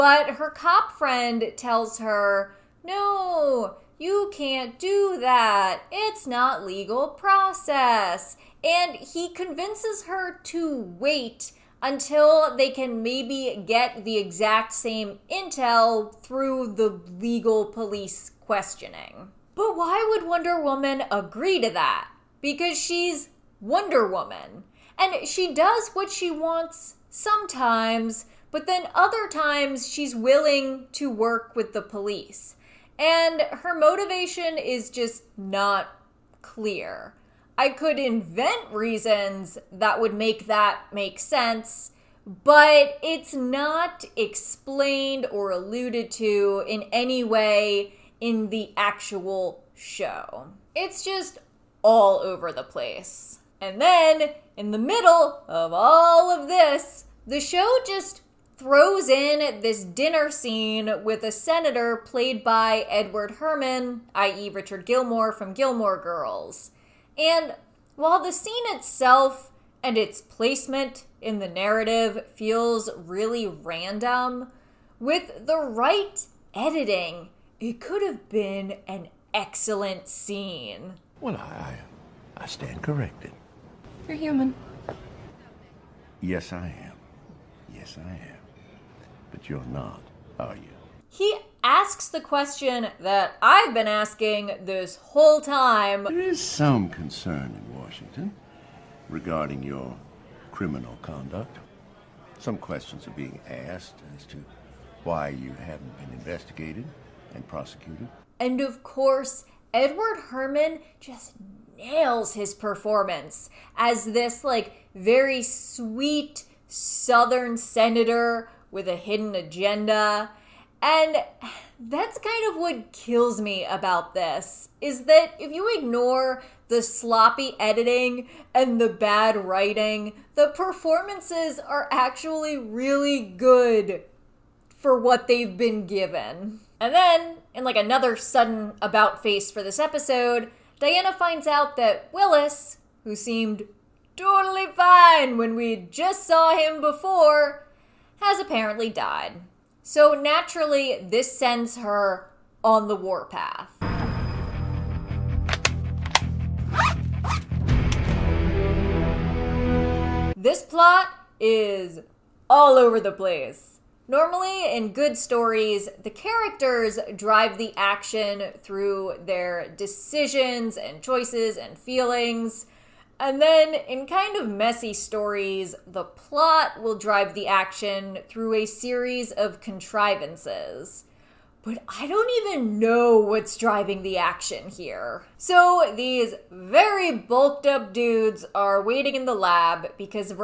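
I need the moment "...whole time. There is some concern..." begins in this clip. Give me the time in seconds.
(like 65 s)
94 s.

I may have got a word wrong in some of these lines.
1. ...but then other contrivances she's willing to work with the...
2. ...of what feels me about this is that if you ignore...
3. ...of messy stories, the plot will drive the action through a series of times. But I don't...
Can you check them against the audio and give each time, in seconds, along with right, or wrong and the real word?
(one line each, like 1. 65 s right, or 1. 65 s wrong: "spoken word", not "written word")
1. 28 s wrong: "times", not "contrivances"
2. 122 s wrong: "kills", not "feels"
3. 174 s wrong: "contrivances", not "times".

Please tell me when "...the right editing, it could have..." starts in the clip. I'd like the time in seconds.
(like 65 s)
75 s.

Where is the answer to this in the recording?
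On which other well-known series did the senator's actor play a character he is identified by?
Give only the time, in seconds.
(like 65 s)
65 s.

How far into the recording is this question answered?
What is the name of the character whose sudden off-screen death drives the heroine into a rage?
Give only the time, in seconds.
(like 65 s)
142 s.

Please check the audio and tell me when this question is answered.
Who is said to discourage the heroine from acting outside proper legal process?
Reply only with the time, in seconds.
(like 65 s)
0 s.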